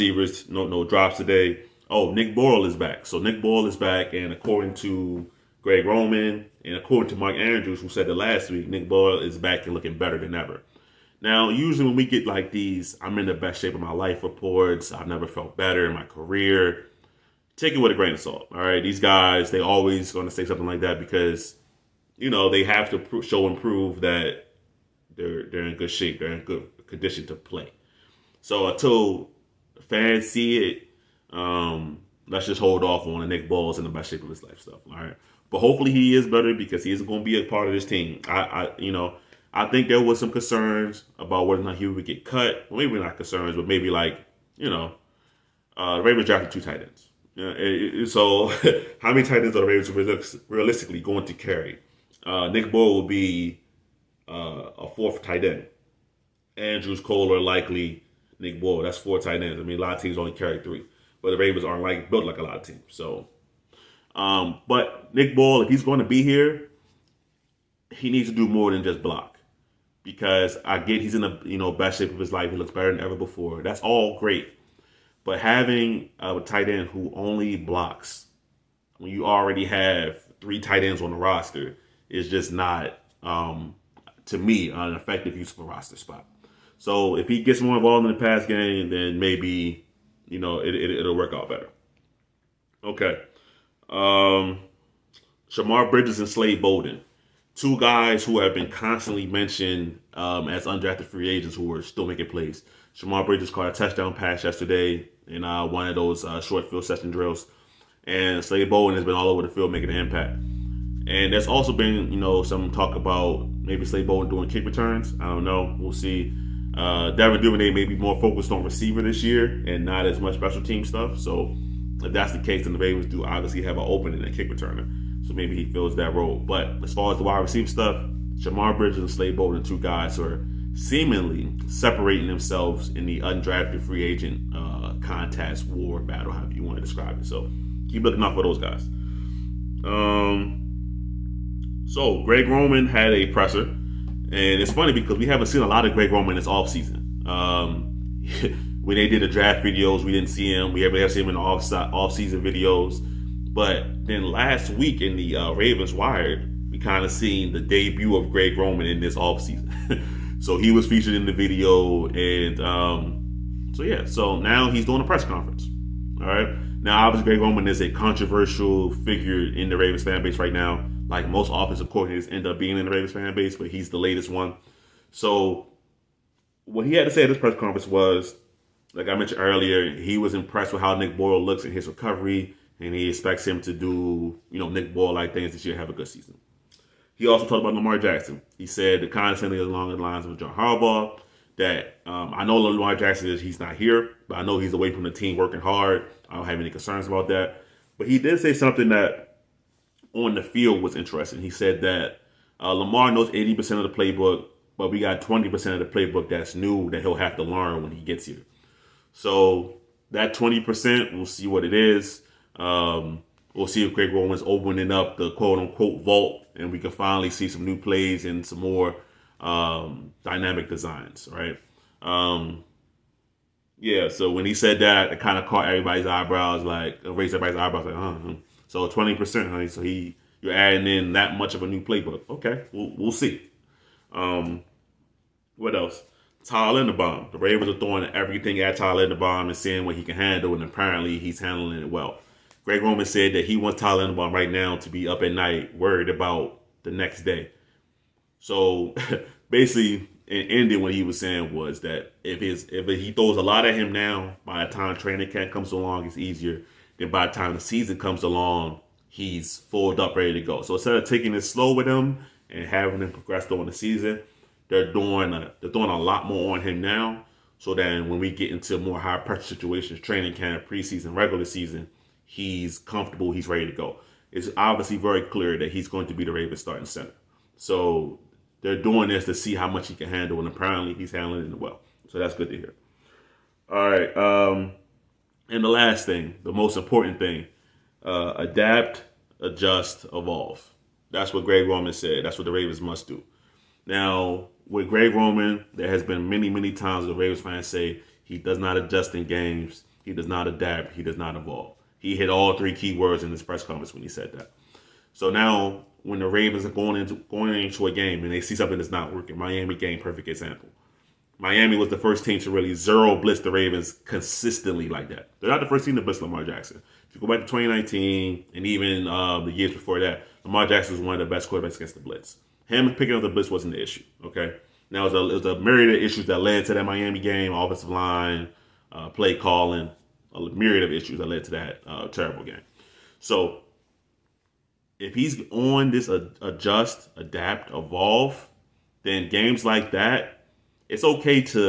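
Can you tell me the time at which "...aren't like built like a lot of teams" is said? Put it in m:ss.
1:01.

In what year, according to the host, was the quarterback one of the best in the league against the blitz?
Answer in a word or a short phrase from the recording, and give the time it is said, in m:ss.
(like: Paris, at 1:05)
2019, at 5:17.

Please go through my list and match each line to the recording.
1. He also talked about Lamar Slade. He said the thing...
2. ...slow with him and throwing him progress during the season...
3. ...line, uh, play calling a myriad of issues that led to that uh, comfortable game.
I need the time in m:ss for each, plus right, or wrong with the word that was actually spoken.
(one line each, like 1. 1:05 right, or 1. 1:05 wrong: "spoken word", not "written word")
1. 3:07 wrong: "Jackson", not "Slade"
2. 4:21 wrong: "having", not "throwing"
3. 5:27 wrong: "terrible", not "comfortable".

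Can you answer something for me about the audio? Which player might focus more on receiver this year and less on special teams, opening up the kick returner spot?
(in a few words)
Devin Duvernay.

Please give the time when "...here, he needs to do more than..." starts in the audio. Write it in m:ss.
1:06.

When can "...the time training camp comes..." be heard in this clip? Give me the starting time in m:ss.
4:14.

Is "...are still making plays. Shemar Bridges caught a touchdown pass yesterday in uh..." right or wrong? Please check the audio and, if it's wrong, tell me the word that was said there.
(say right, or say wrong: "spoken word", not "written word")
right.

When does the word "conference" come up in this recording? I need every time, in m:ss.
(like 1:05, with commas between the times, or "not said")
2:45, 2:57, 5:03.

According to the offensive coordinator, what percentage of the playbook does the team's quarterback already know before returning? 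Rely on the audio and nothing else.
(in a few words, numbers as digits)
80%.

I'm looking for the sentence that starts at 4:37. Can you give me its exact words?
So they're doing this to see how much he can handle, and apparently he's handling it well.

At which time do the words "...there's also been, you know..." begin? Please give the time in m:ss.
1:51.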